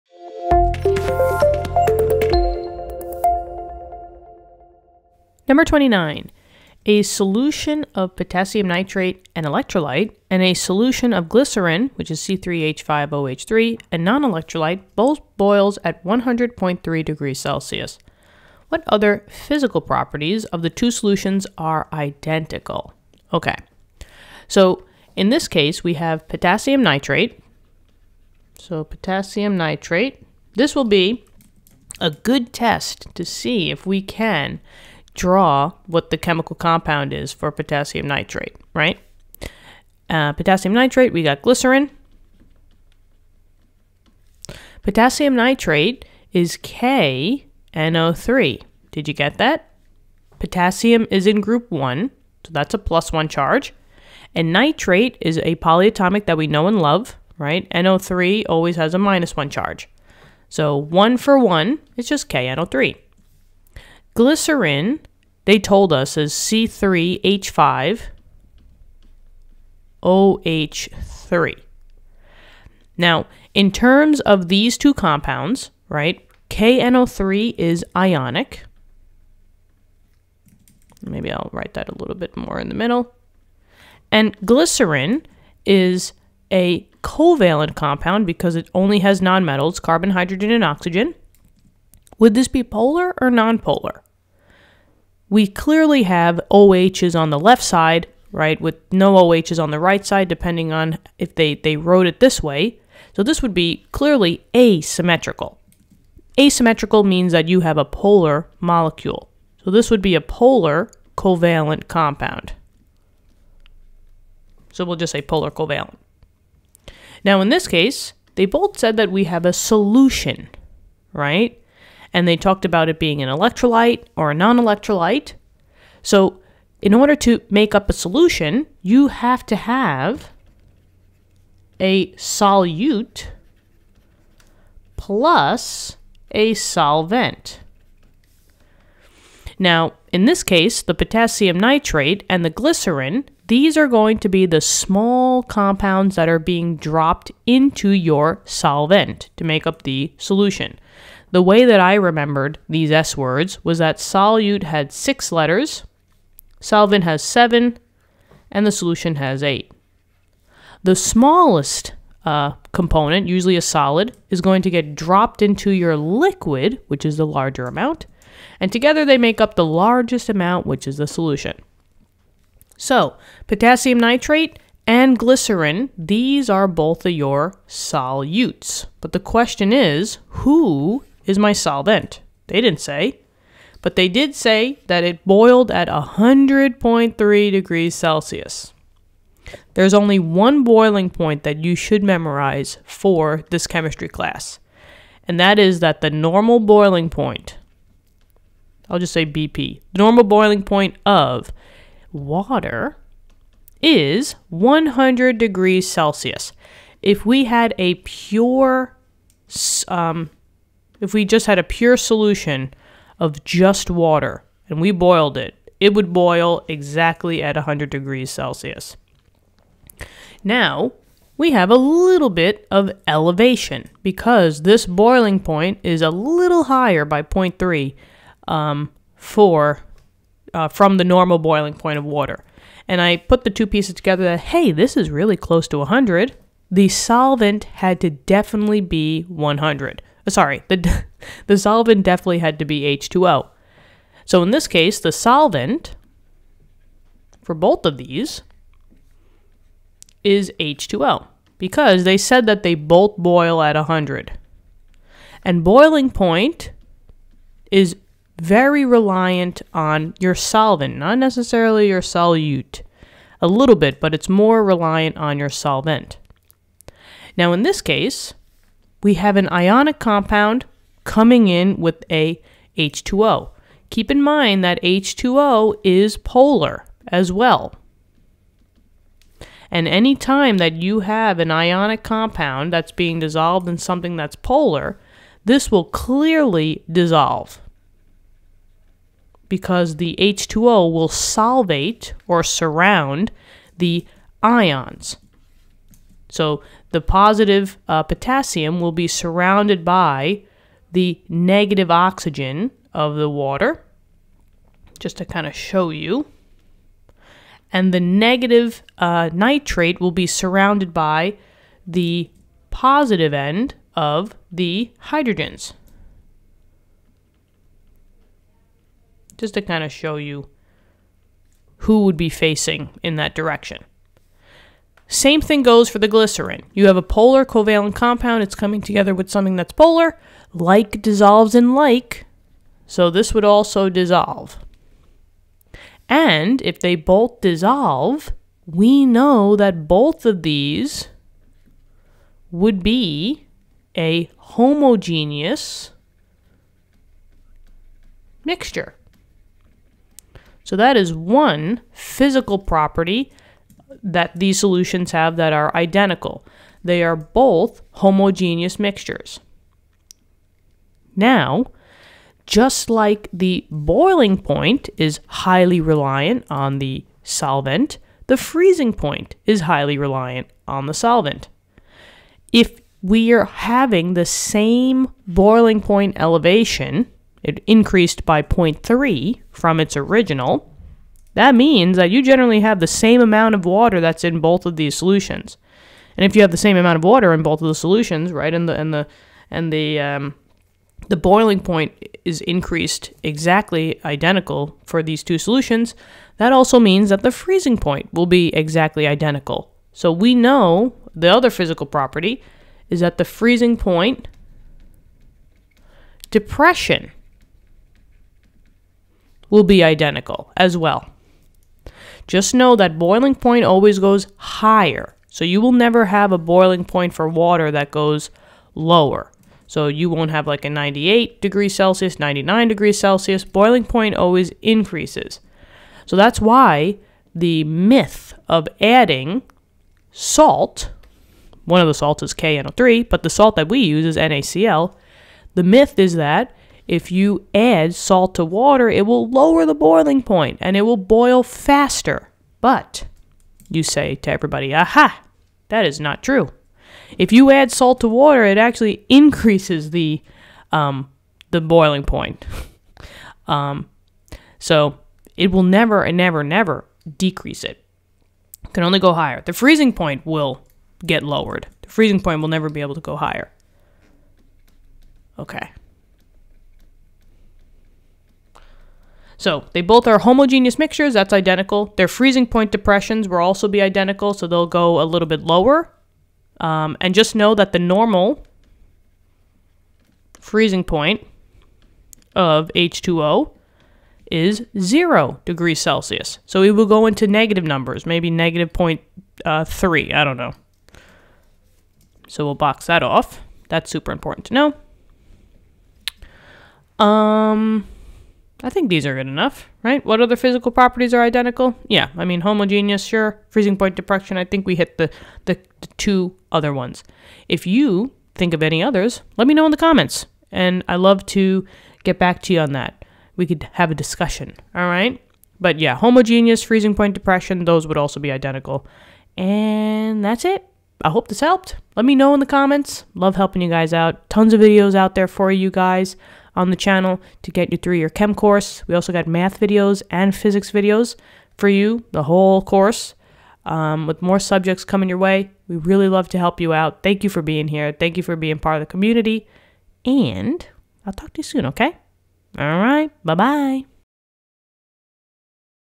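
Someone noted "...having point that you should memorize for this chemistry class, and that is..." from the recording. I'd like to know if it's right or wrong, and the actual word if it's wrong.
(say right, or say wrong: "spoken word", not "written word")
wrong: "boiling", not "having".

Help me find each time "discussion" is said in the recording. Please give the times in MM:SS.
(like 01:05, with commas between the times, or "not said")
08:33.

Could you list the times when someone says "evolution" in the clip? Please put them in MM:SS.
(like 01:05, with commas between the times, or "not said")
not said.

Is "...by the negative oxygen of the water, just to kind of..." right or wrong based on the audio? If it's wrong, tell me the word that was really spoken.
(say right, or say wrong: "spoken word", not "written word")
right.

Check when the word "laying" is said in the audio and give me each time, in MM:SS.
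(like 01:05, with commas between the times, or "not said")
not said.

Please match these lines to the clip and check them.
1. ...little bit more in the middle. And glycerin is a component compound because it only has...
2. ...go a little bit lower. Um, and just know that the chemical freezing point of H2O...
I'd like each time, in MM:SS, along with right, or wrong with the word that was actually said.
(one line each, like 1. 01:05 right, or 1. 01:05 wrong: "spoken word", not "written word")
1. 01:21 wrong: "covalent", not "component"
2. 07:54 wrong: "normal", not "chemical".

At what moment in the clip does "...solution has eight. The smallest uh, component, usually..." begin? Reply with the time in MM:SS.
02:38.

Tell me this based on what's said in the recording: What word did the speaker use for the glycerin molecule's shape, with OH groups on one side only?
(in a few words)
Asymmetrical.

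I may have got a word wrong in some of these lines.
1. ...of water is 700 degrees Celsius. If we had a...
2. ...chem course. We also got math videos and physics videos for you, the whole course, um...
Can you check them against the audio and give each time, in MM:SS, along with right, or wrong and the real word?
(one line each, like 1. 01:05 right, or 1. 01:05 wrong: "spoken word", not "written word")
1. 03:21 wrong: "100", not "700"
2. 08:48 right.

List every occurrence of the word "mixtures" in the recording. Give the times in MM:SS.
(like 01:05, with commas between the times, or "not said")
05:48, 05:58, 07:50.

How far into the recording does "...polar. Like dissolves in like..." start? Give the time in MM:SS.
05:29.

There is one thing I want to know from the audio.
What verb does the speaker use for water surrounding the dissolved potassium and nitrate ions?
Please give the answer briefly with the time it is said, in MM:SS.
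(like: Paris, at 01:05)
Solvate, at 04:51.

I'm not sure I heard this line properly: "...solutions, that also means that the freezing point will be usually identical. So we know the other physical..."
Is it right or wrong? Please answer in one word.
wrong.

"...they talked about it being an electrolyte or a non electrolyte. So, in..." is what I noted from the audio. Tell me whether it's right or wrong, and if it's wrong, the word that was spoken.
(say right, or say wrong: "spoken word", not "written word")
right.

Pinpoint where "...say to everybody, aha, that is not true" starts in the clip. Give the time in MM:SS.
07:23.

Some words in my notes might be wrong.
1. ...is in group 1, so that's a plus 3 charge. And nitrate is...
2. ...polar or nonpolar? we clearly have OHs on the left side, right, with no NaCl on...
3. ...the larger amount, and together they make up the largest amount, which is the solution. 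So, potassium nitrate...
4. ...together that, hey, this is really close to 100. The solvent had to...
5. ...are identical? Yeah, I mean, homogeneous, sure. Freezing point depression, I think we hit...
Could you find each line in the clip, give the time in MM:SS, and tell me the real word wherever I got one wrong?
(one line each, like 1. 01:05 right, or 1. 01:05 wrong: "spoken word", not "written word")
1. 00:51 wrong: "1", not "3"
2. 01:32 wrong: "OHs", not "NaCl"
3. 02:47 right
4. 03:53 right
5. 08:21 right.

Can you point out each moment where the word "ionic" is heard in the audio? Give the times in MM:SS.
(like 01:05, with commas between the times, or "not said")
01:17, 04:29, 04:41.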